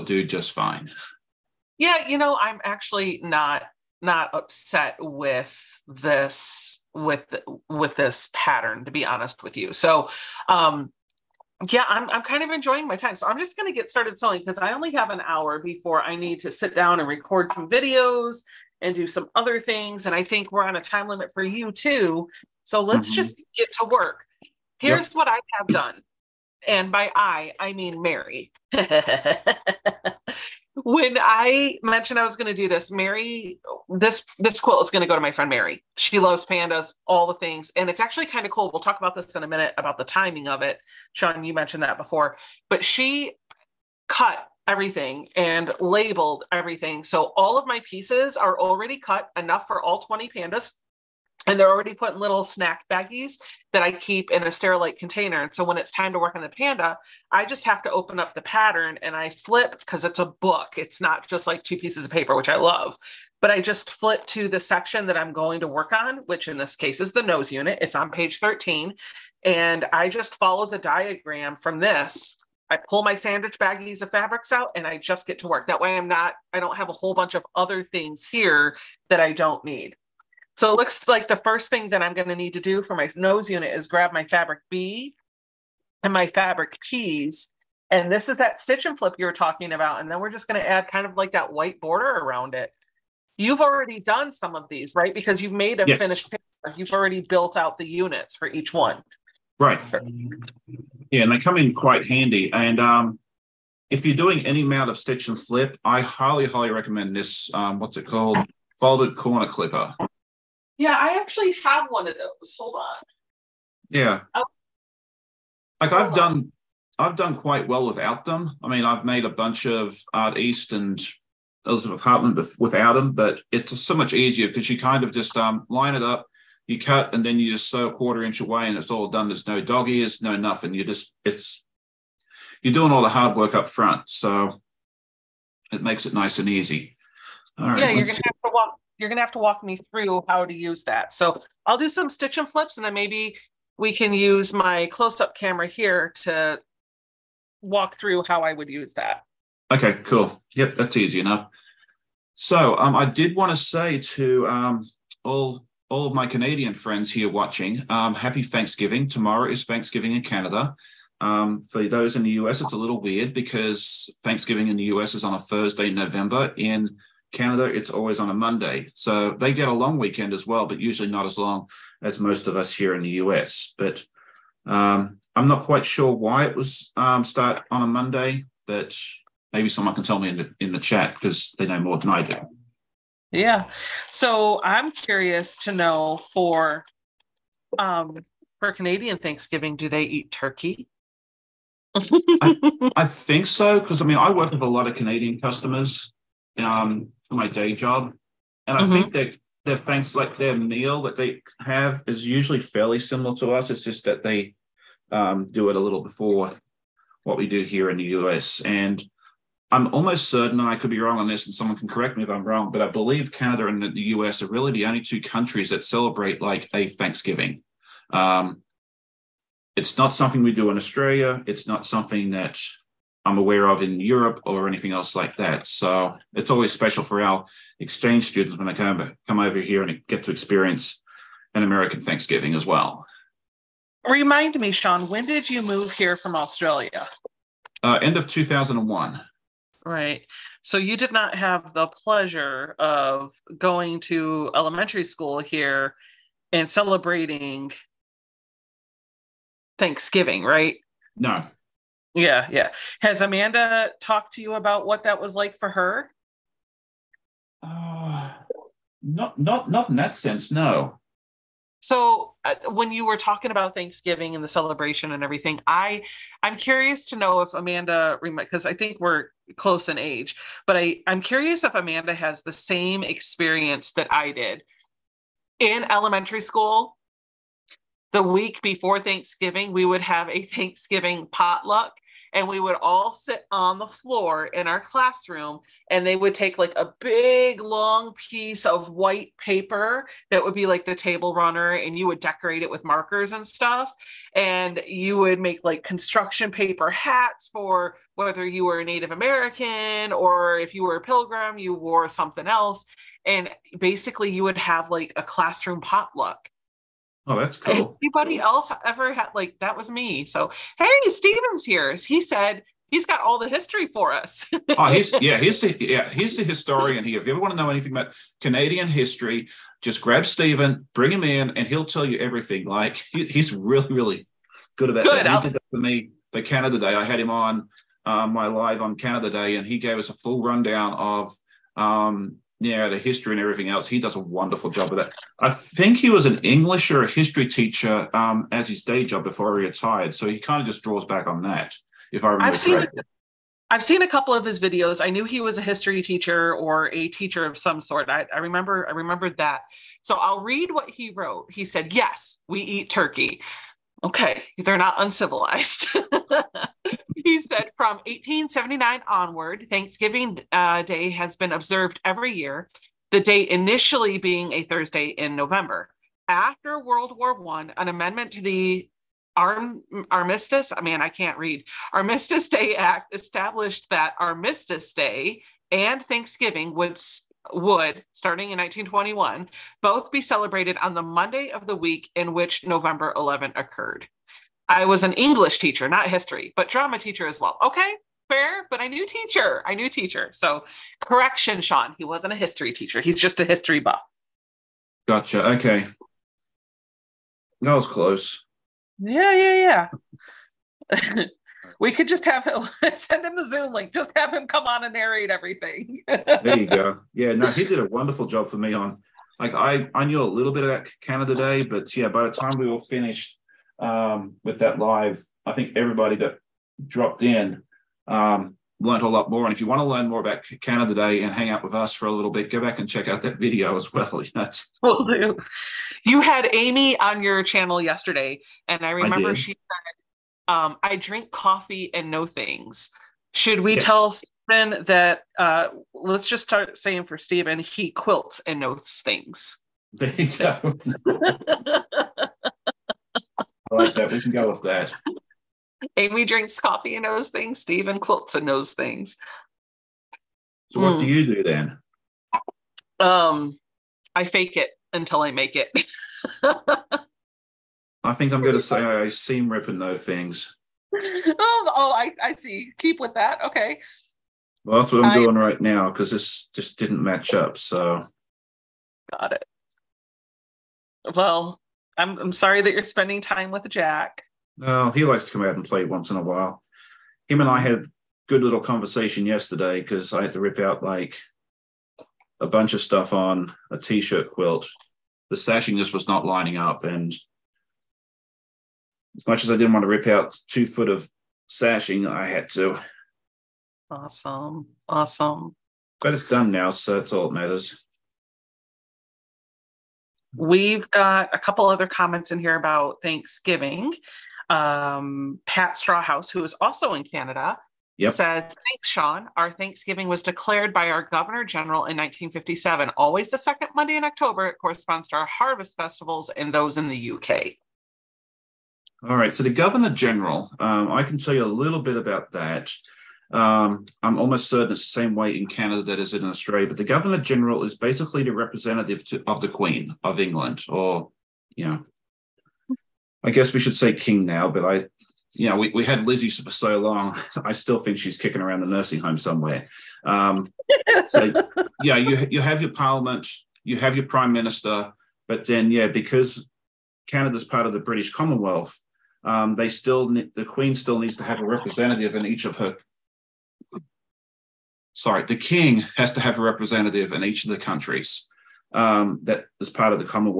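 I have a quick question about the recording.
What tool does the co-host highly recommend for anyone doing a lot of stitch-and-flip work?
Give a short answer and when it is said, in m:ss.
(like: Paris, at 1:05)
Folded corner clipper, at 1:48.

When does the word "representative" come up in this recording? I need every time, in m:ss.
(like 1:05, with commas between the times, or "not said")
8:48, 9:11, 9:16.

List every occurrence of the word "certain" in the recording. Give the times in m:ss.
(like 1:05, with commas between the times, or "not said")
3:30, 8:44.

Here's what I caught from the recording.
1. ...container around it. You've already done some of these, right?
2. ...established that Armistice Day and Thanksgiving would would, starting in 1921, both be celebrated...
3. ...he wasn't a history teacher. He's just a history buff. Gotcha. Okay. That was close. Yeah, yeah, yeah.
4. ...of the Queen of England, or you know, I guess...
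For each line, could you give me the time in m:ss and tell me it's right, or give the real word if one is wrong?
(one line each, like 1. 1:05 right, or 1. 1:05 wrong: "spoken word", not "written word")
1. 1:31 wrong: "border", not "container"
2. 6:13 right
3. 6:31 right
4. 8:49 right.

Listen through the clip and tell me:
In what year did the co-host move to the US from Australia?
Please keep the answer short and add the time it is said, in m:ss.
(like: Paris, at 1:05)
2001, at 3:58.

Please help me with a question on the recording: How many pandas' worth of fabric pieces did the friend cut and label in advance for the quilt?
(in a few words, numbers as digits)
20.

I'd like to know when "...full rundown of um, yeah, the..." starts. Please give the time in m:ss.
5:30.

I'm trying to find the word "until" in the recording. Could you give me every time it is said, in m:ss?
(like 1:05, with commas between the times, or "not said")
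7:34.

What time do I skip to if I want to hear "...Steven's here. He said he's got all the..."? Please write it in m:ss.
5:11.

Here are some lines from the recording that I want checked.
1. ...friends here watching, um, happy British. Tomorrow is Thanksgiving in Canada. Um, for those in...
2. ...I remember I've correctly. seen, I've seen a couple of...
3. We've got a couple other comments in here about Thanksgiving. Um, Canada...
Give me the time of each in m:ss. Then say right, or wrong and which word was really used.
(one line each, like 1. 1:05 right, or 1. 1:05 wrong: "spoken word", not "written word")
1. 2:36 wrong: "Thanksgiving", not "British"
2. 5:42 right
3. 8:20 wrong: "Pat", not "Canada".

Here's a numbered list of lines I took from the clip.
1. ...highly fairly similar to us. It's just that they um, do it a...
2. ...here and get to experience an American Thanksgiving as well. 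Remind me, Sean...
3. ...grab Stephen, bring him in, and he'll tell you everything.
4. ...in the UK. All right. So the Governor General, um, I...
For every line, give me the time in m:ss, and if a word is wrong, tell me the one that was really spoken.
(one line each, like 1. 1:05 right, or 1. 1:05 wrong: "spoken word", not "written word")
1. 3:22 wrong: "usually", not "highly"
2. 3:49 right
3. 5:20 right
4. 8:36 right.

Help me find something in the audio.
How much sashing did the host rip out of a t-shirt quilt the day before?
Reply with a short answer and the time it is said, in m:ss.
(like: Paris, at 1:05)
2 feet, at 8:10.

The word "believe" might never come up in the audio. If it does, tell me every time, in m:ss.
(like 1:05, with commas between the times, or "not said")
3:32.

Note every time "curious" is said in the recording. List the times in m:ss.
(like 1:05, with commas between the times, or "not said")
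3:04, 4:26, 4:31.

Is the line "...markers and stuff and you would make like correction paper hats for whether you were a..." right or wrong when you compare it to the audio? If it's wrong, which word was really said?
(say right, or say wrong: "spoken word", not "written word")
wrong: "construction", not "correction".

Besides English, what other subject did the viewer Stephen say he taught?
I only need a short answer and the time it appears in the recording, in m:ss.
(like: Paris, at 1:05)
Drama, at 6:26.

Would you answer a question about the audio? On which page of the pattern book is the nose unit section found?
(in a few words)
13.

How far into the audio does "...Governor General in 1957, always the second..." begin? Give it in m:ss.
8:31.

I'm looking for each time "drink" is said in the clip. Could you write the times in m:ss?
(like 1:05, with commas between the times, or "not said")
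7:10, 7:26.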